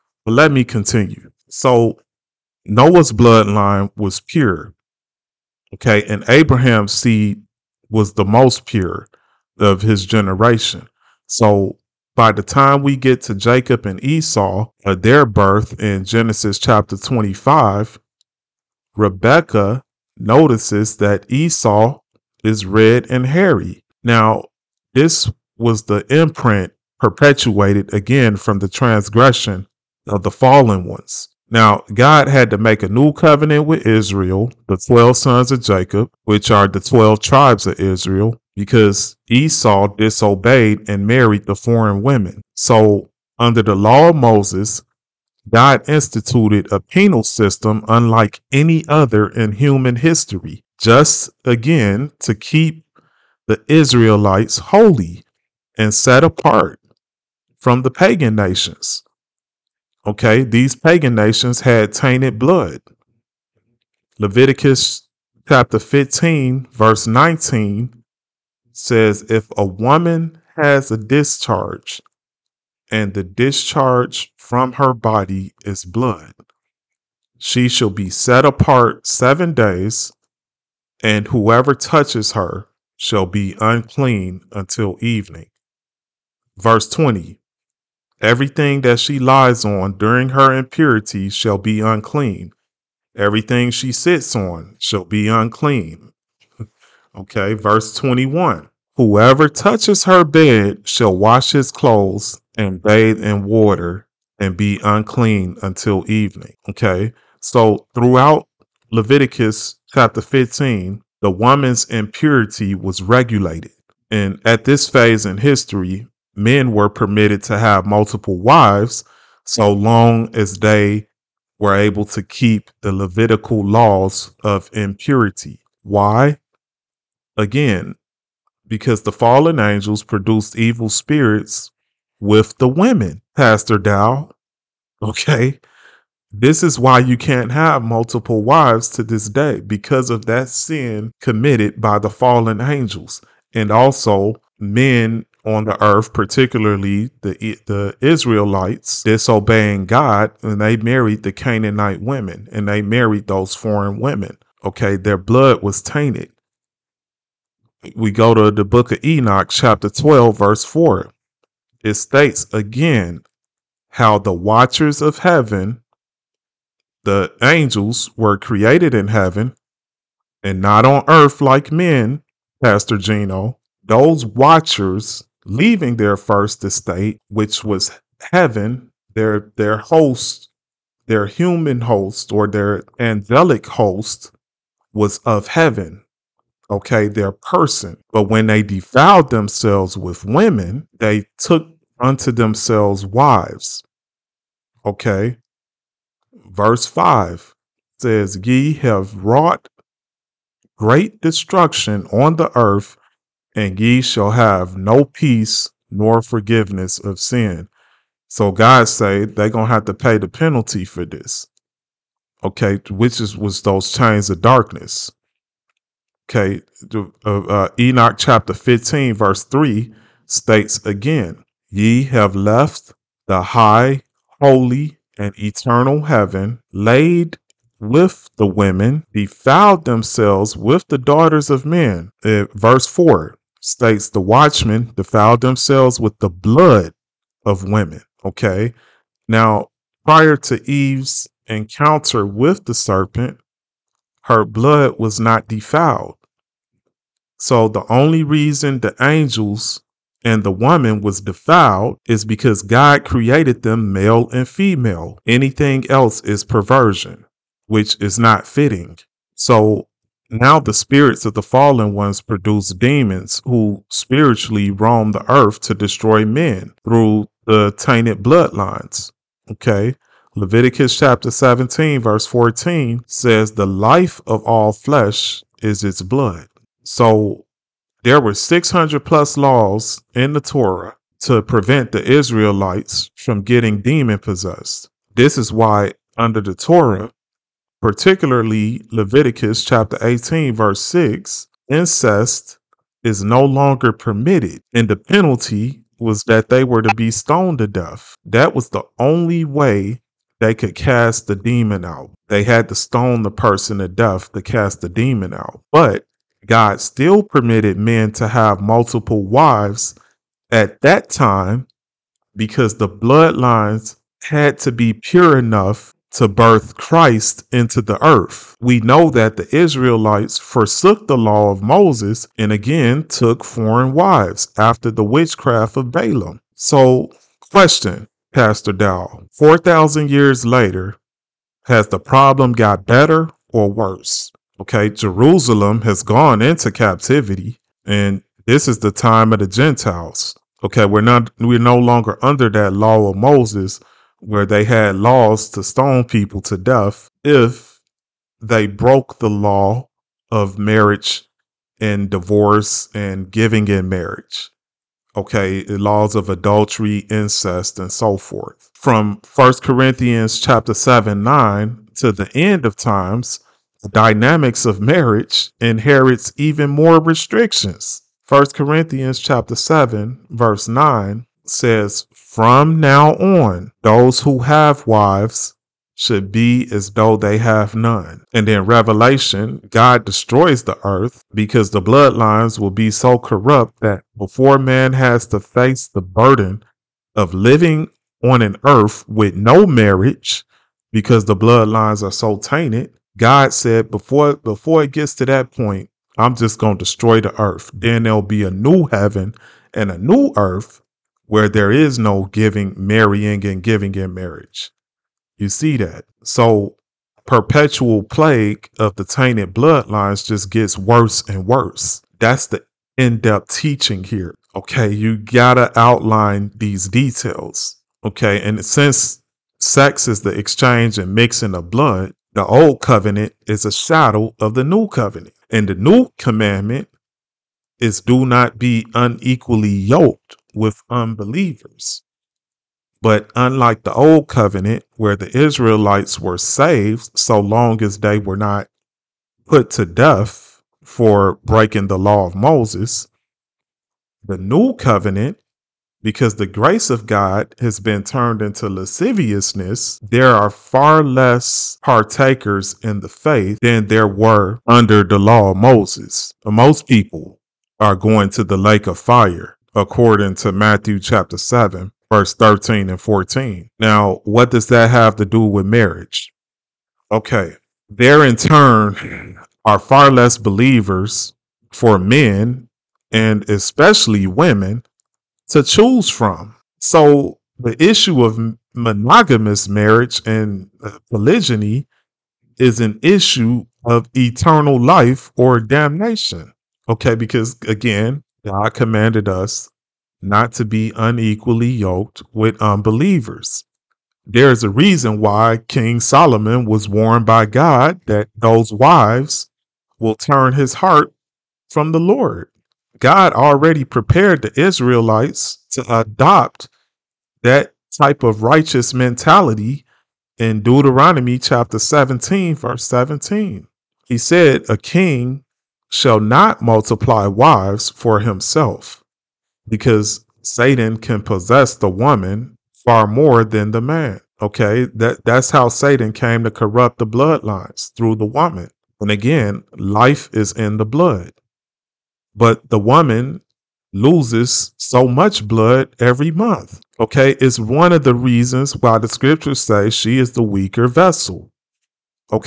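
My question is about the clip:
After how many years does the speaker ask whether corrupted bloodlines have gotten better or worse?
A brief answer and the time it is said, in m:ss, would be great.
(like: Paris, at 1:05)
4,000, at 5:29.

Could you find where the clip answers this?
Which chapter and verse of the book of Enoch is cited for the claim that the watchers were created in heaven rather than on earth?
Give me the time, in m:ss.
2:39.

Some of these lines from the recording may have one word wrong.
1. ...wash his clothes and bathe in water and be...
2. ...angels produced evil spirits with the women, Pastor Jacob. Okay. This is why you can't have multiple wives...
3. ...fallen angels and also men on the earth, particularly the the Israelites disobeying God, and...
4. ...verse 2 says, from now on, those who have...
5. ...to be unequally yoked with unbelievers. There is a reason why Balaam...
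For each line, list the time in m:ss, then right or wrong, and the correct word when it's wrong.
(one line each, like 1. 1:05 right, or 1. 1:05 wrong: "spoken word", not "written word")
1. 1:41 right
2. 2:09 wrong: "Dow", not "Jacob"
3. 2:22 right
4. 6:10 wrong: "9", not "2"
5. 8:10 wrong: "King", not "Balaam".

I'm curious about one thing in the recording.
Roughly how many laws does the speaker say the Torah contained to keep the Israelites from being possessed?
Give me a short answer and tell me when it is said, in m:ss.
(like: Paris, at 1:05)
600 plus, at 4:38.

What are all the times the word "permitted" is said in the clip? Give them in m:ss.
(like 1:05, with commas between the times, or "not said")
1:56, 4:53, 5:07.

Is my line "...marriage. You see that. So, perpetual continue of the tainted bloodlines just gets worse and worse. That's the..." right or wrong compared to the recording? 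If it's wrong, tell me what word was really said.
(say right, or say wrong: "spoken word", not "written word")
wrong: "plague", not "continue".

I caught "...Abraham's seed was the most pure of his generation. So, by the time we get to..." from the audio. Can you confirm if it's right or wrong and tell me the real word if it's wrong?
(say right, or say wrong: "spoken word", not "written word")
right.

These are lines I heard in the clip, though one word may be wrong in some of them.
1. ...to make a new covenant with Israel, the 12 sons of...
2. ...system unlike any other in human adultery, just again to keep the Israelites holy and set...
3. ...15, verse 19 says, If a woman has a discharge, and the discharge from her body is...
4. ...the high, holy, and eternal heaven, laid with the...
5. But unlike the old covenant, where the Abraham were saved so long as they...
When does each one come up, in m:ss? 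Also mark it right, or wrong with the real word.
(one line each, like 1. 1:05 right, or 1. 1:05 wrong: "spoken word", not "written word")
1. 0:32 right
2. 0:47 wrong: "history", not "adultery"
3. 1:05 right
4. 3:43 right
5. 7:13 wrong: "Israelites", not "Abraham".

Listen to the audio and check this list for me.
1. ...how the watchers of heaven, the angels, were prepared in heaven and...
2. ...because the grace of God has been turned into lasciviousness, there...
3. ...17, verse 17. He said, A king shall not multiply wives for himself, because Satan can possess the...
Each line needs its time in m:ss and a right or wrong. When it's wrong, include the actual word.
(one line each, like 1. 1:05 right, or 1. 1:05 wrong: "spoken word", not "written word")
1. 2:43 wrong: "created", not "prepared"
2. 7:26 right
3. 8:31 right.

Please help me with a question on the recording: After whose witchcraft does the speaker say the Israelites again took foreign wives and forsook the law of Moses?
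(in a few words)
Balaam.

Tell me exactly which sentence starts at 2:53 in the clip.
Those watchers leaving their first estate, which was heaven, their their host, their human host or their angelic host was of heaven.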